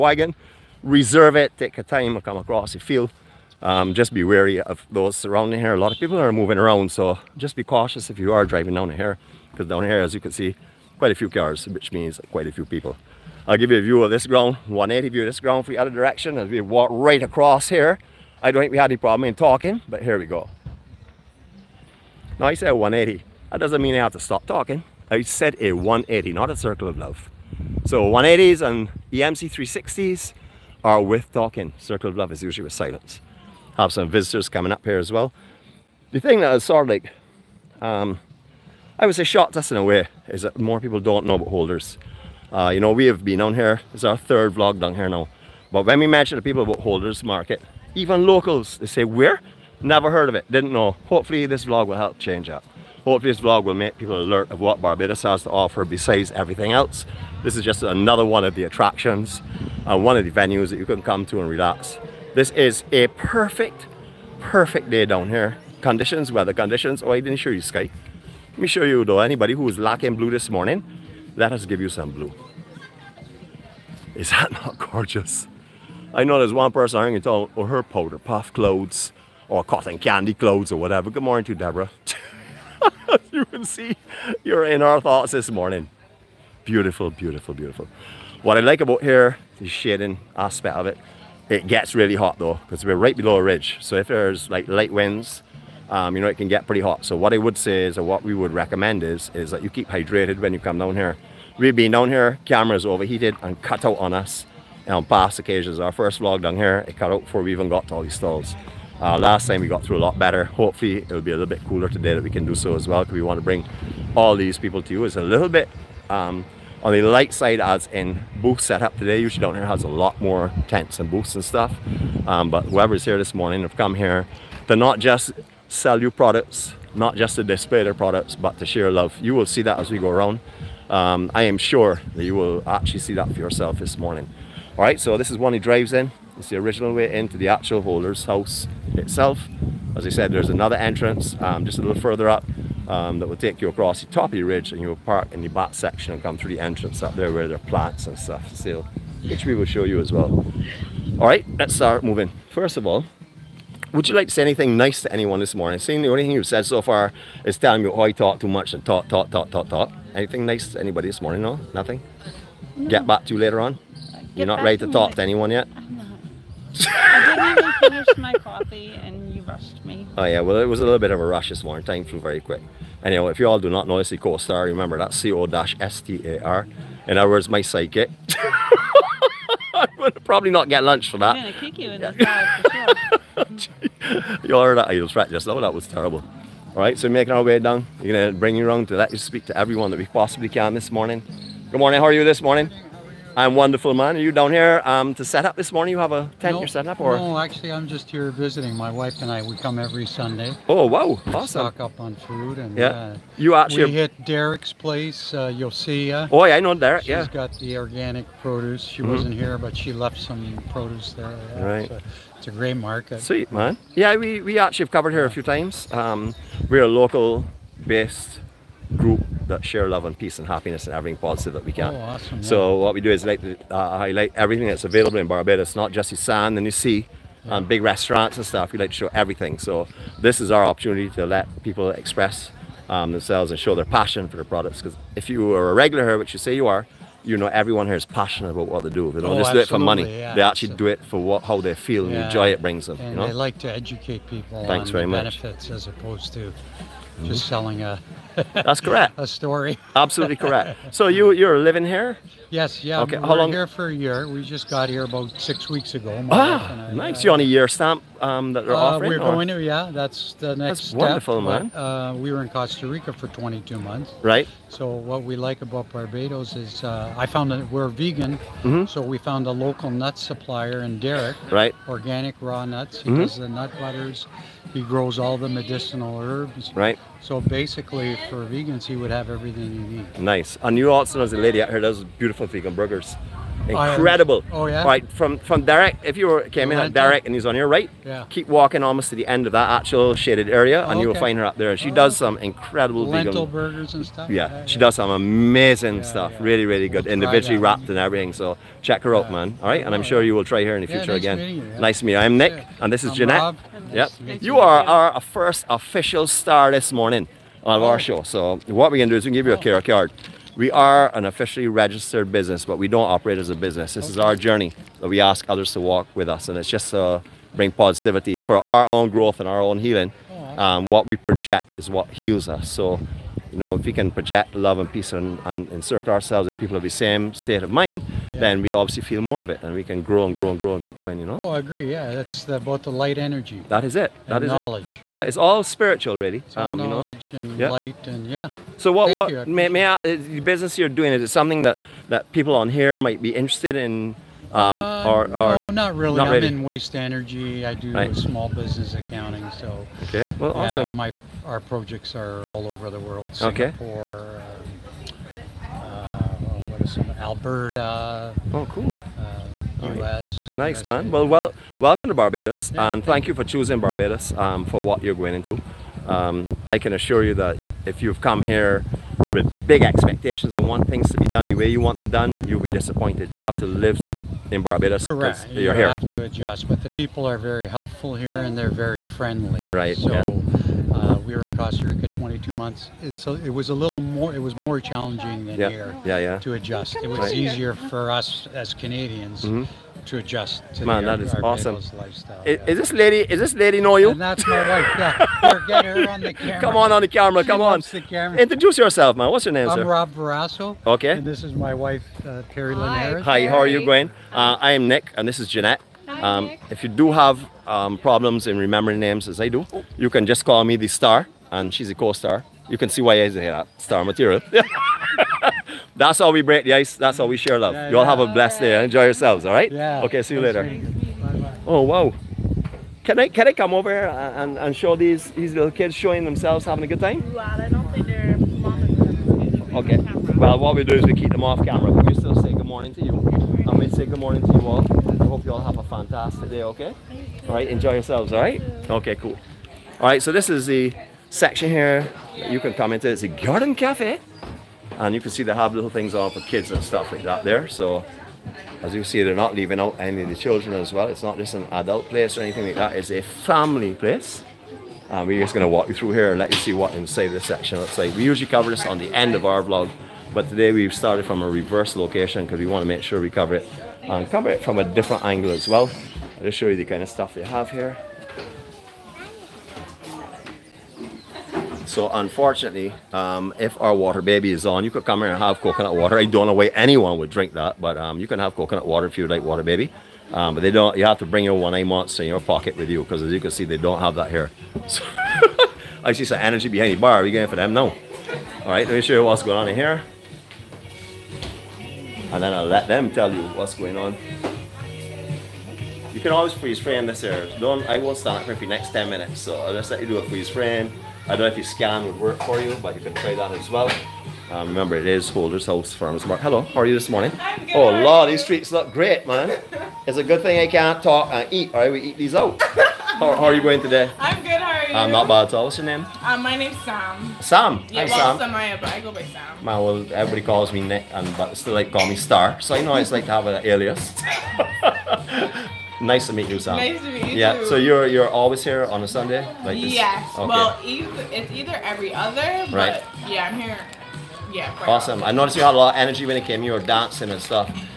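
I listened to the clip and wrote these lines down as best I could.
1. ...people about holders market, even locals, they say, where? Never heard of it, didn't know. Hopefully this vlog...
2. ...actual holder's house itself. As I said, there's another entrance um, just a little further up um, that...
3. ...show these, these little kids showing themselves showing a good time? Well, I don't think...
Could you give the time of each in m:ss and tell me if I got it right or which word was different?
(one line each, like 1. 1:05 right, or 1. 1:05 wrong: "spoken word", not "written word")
1. 0:46 right
2. 2:17 right
3. 7:04 wrong: "having", not "showing".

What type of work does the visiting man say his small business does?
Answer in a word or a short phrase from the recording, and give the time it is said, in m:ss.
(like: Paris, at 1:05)
accounting, at 5:48.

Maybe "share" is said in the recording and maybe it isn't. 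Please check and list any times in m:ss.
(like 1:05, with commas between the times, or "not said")
2:08, 3:39, 6:57.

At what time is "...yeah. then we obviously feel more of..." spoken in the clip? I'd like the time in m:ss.
5:28.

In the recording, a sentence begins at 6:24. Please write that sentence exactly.
It was more challenging than yeah.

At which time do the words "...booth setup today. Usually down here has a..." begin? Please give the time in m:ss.
1:58.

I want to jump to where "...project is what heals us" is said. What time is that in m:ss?
5:21.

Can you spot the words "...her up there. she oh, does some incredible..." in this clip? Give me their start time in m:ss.
4:51.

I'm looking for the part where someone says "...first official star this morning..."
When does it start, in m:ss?
5:05.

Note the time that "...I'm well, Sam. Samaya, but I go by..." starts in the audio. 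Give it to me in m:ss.
8:38.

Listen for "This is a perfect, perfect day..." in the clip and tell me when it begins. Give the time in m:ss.
1:02.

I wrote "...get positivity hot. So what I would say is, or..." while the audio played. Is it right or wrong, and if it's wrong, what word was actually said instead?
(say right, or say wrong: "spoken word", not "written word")
wrong: "pretty", not "positivity".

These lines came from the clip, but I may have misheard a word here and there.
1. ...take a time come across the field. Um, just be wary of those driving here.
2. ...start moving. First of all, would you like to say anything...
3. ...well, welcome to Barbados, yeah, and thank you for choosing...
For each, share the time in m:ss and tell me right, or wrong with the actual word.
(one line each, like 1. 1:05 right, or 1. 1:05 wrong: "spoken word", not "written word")
1. 0:01 wrong: "surrounding", not "driving"
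2. 2:31 right
3. 6:01 right.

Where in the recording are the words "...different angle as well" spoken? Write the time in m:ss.
7:44.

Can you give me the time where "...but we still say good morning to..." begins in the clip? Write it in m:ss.
7:11.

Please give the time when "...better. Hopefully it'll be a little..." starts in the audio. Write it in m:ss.
1:50.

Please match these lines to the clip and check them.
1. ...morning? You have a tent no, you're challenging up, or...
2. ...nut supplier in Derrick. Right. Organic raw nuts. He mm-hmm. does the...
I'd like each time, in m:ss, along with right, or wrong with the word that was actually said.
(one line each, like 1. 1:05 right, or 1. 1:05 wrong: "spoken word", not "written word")
1. 3:15 wrong: "setting", not "challenging"
2. 4:29 right.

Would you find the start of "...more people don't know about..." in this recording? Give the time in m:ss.
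0:40.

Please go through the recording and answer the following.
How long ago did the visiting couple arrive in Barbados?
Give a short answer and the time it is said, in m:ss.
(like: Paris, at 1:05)
six weeks, at 4:15.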